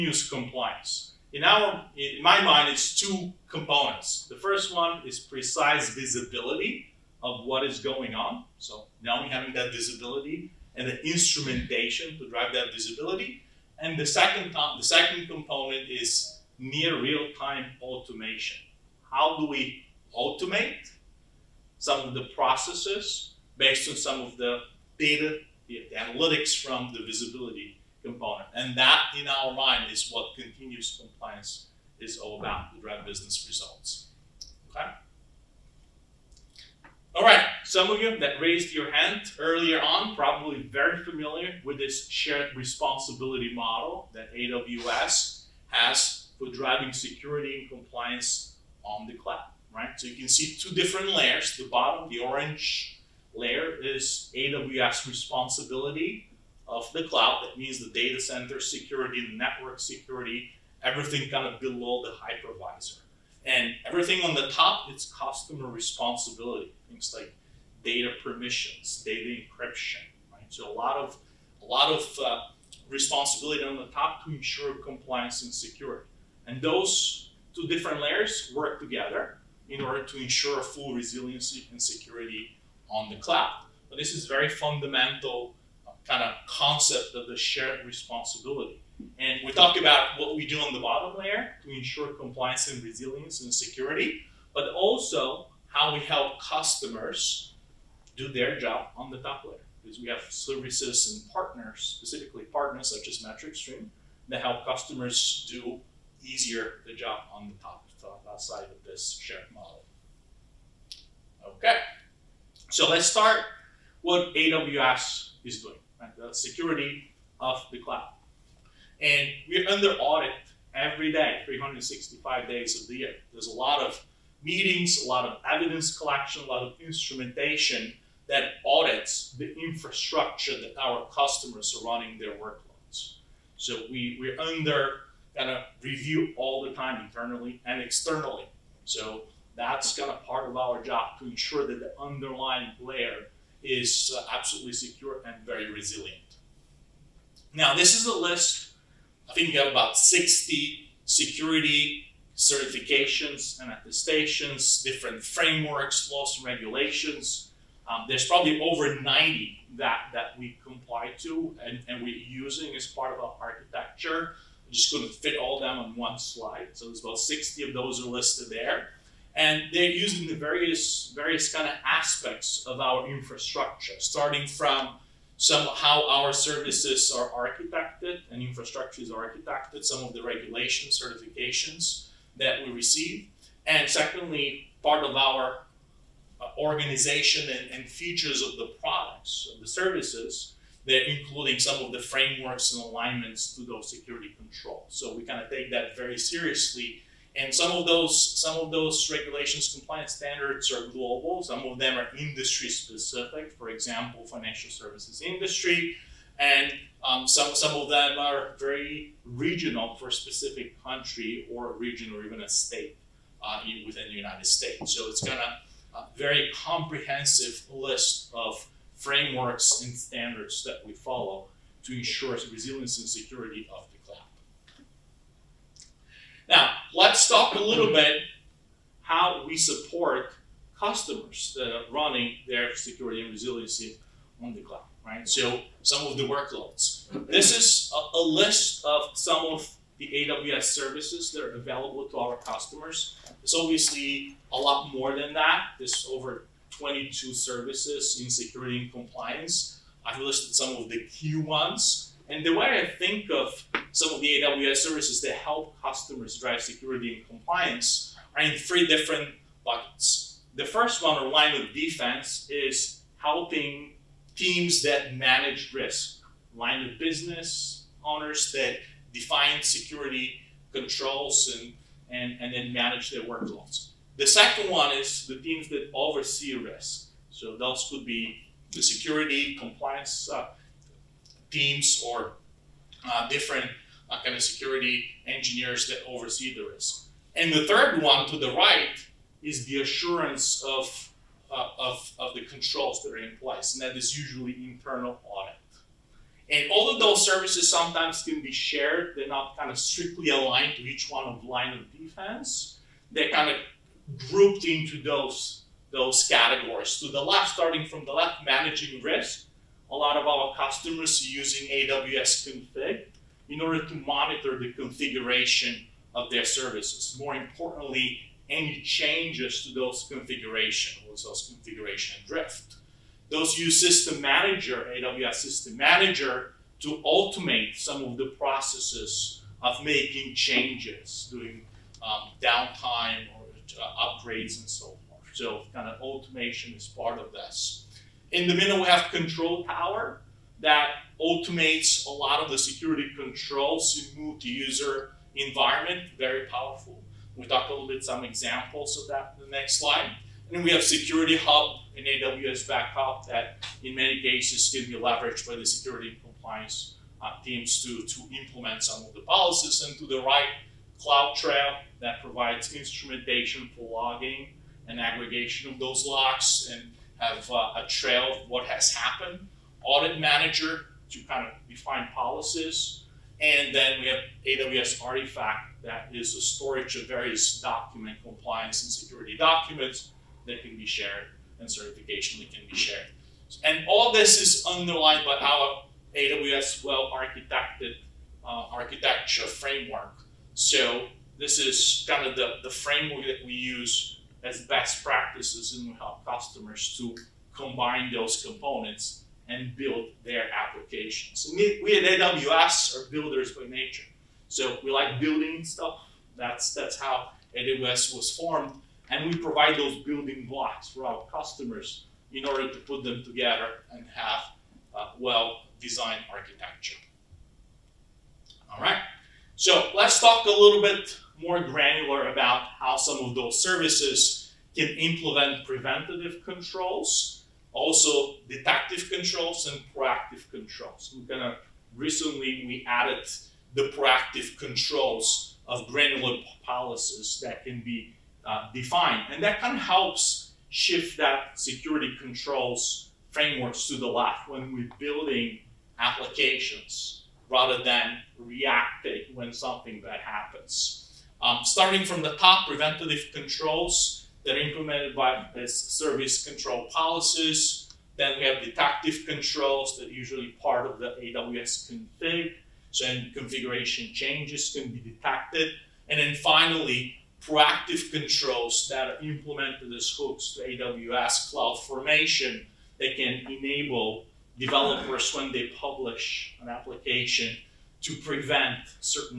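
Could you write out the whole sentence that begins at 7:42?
So any configuration changes can be detected.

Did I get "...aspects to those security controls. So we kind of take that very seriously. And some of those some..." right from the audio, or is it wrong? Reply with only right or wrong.
wrong.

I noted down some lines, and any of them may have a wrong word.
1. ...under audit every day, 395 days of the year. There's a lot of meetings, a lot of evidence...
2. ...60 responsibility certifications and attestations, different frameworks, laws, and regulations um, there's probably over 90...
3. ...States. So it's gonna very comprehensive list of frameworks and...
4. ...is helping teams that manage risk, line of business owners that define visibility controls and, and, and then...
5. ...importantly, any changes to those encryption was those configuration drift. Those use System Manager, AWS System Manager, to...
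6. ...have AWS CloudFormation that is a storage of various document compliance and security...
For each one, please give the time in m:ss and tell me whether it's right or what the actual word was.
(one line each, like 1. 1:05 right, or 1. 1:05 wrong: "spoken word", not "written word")
1. 1:59 wrong: "365", not "395"
2. 2:29 wrong: "security", not "responsibility"
3. 3:34 right
4. 4:22 wrong: "security", not "visibility"
5. 5:17 wrong: "configuration", not "encryption"
6. 6:14 wrong: "Artifact", not "CloudFormation".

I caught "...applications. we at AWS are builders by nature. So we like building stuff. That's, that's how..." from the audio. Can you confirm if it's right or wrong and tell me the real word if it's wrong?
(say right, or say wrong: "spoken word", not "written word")
right.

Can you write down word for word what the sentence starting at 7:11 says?
We're gonna, recently we added the proactive controls of granular policies that can be uh, defined.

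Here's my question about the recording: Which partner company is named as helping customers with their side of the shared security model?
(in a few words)
MetricStream.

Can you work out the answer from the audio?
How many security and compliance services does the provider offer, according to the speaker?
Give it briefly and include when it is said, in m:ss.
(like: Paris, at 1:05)
over 22, at 4:06.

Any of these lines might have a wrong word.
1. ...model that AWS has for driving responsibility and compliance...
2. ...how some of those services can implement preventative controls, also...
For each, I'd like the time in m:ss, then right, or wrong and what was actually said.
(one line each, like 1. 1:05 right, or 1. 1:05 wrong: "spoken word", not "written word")
1. 0:43 wrong: "security", not "responsibility"
2. 7:02 right.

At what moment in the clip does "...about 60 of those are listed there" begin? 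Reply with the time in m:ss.
2:47.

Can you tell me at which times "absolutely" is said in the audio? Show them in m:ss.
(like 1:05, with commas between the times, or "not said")
2:24.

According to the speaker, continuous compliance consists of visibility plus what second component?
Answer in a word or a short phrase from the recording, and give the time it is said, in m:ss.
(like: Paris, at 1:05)
near real-time automation, at 0:16.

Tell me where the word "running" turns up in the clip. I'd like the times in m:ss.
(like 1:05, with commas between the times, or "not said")
2:11, 3:51.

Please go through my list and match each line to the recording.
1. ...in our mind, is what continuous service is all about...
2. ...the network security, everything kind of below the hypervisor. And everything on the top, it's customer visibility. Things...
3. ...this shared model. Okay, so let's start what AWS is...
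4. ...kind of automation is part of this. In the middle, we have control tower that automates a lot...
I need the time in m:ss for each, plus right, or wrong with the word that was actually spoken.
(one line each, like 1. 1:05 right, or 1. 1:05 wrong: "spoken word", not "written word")
1. 0:29 wrong: "compliance", not "service"
2. 0:59 wrong: "responsibility", not "visibility"
3. 1:48 right
4. 5:35 right.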